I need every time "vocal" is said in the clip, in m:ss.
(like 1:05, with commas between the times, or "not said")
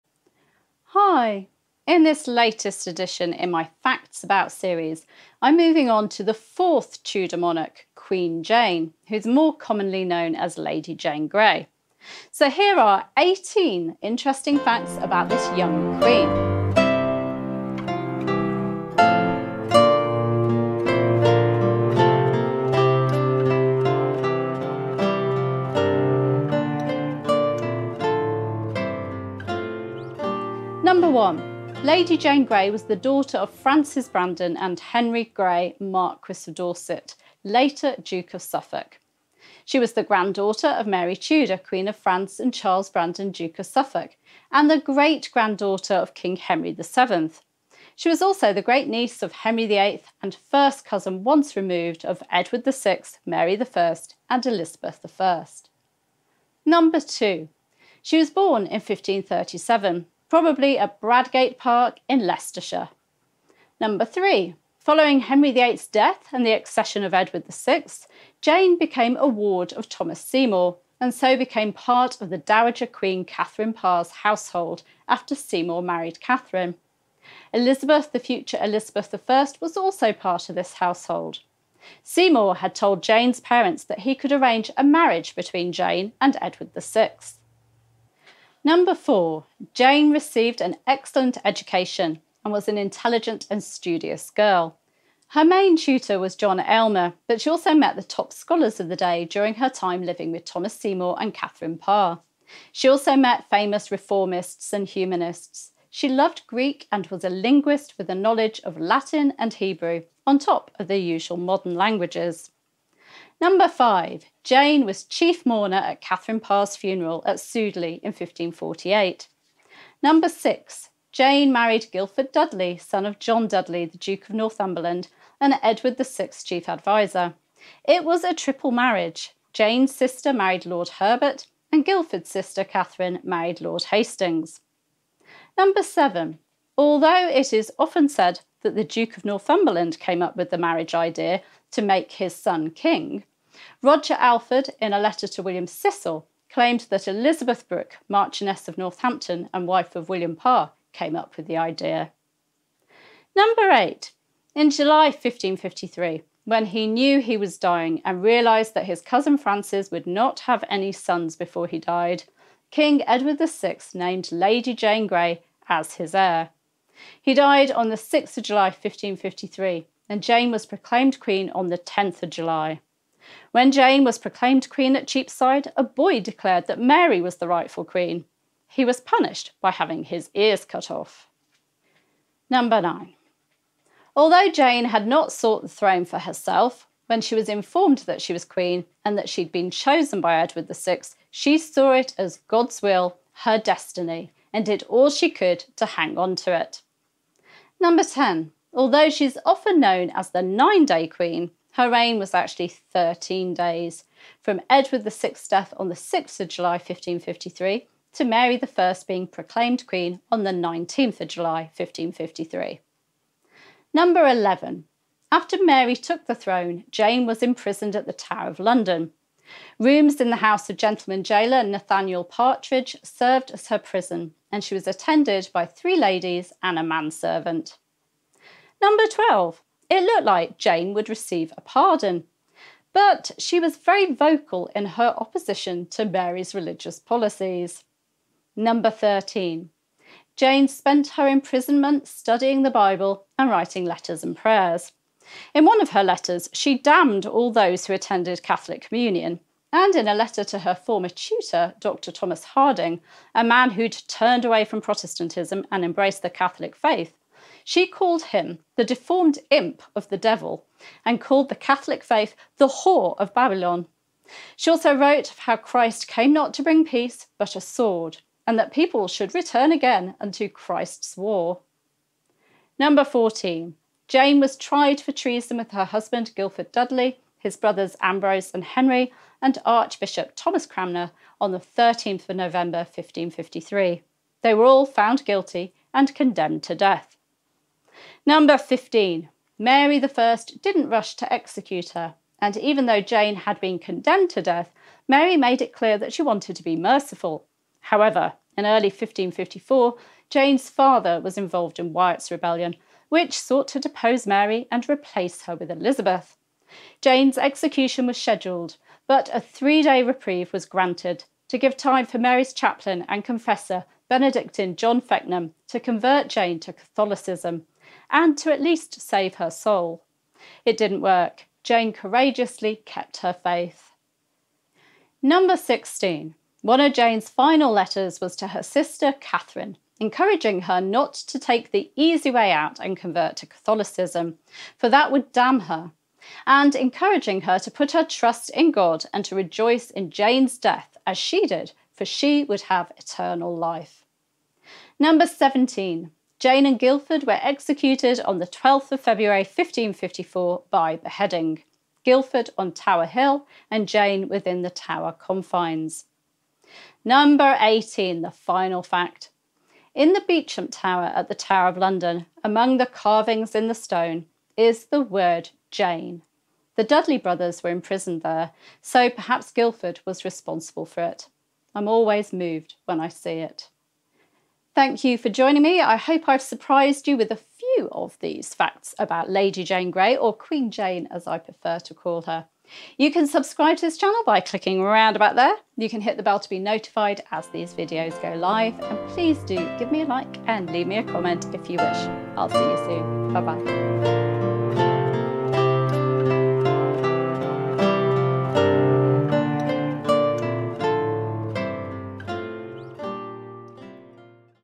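3:54.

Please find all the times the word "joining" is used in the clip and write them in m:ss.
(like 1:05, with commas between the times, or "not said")
6:15.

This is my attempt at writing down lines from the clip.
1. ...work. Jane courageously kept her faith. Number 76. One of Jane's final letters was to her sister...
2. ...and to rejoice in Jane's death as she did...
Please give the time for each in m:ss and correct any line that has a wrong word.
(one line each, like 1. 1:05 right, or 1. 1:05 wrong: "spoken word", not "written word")
1. 5:20 wrong: "16", not "76"
2. 5:39 right.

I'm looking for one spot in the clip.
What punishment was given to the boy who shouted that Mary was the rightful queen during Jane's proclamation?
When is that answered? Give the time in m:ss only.
2:59.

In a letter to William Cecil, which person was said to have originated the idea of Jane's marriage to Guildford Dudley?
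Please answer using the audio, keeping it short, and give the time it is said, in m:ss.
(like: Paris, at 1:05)
Roger Alford, at 2:23.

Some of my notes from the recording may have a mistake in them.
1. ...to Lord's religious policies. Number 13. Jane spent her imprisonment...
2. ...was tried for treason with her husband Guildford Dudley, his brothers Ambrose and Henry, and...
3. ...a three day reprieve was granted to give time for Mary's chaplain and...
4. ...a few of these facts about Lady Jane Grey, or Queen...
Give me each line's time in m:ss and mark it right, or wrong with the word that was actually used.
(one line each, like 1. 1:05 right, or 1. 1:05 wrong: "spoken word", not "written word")
1. 3:55 wrong: "Mary", not "Lord"
2. 4:34 right
3. 5:09 right
4. 6:17 right.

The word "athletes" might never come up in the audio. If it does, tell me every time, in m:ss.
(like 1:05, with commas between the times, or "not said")
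not said.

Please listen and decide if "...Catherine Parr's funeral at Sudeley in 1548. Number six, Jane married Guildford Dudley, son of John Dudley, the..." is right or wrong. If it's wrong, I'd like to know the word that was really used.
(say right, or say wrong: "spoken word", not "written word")
right.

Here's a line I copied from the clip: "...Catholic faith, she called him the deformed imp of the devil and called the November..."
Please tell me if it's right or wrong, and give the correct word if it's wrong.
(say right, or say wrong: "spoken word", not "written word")
wrong: "Catholic", not "November".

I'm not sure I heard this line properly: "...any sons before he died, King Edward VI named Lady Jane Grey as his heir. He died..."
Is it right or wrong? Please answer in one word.
right.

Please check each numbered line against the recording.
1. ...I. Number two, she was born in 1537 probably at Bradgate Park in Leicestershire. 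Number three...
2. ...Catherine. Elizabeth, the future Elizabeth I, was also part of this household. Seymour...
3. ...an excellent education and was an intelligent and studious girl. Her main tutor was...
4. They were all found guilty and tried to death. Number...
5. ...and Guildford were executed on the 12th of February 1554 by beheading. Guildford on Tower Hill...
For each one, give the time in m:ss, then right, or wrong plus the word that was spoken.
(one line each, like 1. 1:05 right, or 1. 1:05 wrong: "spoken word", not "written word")
1. 0:55 right
2. 1:16 right
3. 1:30 right
4. 4:44 wrong: "condemned", not "tried"
5. 5:46 right.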